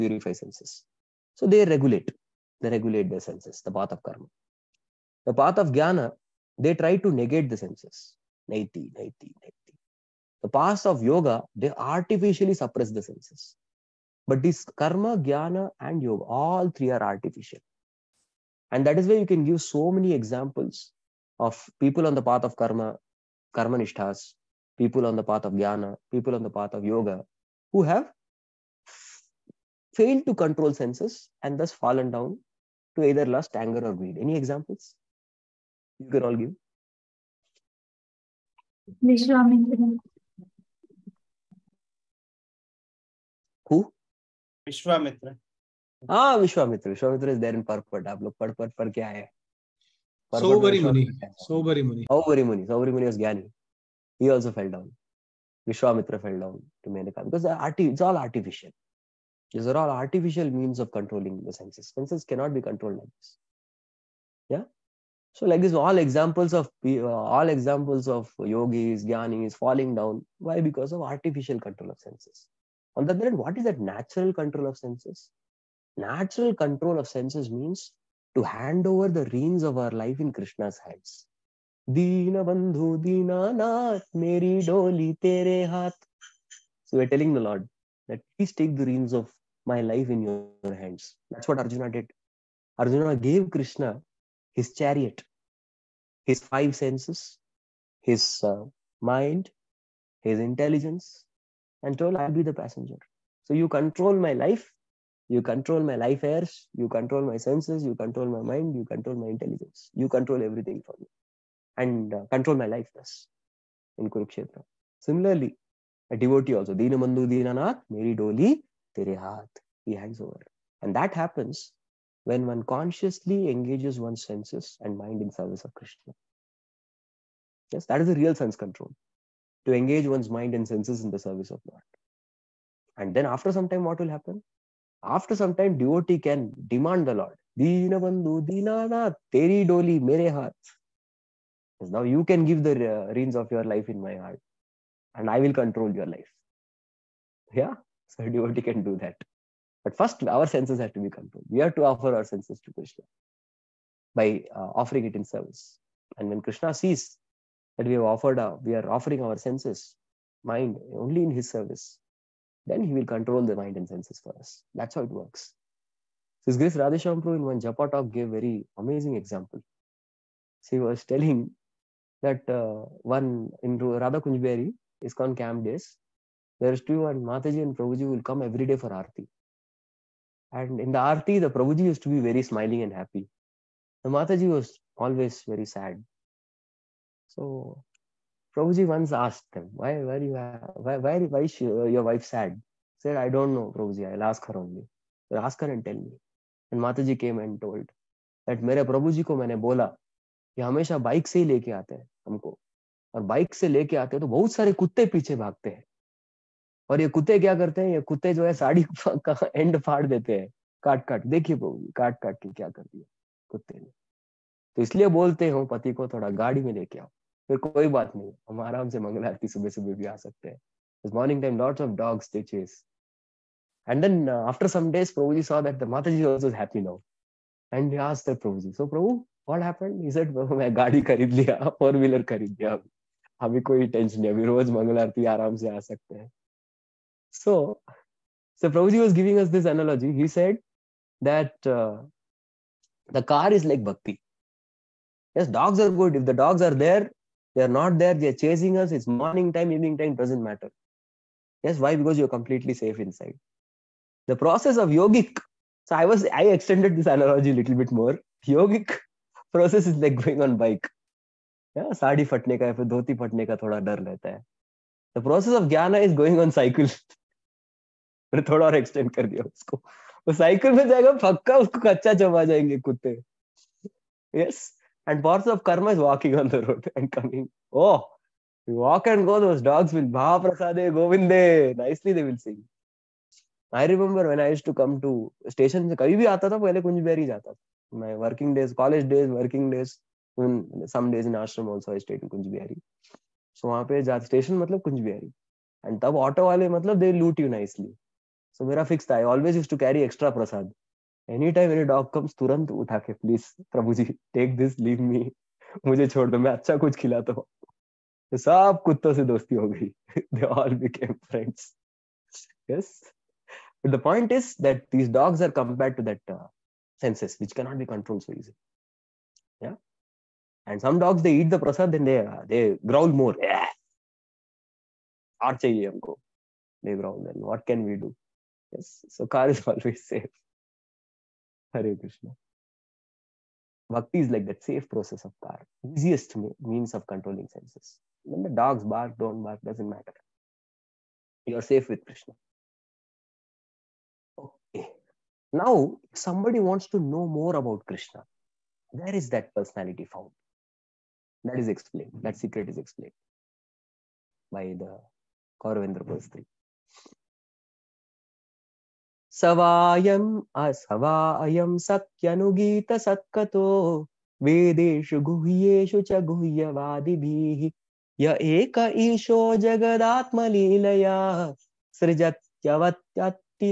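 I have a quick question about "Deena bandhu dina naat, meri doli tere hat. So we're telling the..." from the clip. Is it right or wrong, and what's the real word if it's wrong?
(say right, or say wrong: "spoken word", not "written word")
right.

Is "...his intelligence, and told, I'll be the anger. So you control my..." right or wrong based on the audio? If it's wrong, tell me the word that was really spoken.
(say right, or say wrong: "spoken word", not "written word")
wrong: "passenger", not "anger".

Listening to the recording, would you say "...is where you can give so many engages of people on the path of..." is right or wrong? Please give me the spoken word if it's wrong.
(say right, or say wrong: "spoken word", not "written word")
wrong: "examples", not "engages".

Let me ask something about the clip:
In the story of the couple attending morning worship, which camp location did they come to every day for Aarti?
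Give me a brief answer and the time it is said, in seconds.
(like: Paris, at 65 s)
Radha Kunjberi, at 173 s.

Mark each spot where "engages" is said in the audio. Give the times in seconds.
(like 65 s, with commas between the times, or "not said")
123 s, 129 s.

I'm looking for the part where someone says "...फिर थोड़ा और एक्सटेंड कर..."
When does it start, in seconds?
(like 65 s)
268 s.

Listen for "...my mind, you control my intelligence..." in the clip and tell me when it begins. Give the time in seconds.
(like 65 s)
108 s.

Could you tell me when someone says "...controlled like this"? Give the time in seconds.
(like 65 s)
62 s.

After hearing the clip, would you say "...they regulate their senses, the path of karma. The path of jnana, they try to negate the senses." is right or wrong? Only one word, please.
right.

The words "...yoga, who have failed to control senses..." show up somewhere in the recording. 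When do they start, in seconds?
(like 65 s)
26 s.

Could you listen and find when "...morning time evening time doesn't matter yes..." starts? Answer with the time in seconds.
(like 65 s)
249 s.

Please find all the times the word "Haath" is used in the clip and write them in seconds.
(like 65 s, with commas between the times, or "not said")
119 s, 140 s.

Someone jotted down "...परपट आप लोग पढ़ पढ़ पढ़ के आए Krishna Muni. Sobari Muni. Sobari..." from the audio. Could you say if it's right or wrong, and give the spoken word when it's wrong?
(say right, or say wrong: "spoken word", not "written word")
wrong: "Sobari", not "Krishna".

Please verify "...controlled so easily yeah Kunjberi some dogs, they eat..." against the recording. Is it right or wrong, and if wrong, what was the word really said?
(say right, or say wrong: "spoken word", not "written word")
wrong: "And", not "Kunjberi".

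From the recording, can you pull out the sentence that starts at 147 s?
Yeah, so a devotee can do that.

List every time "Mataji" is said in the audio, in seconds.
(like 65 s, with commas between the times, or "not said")
177 s, 184 s, 196 s.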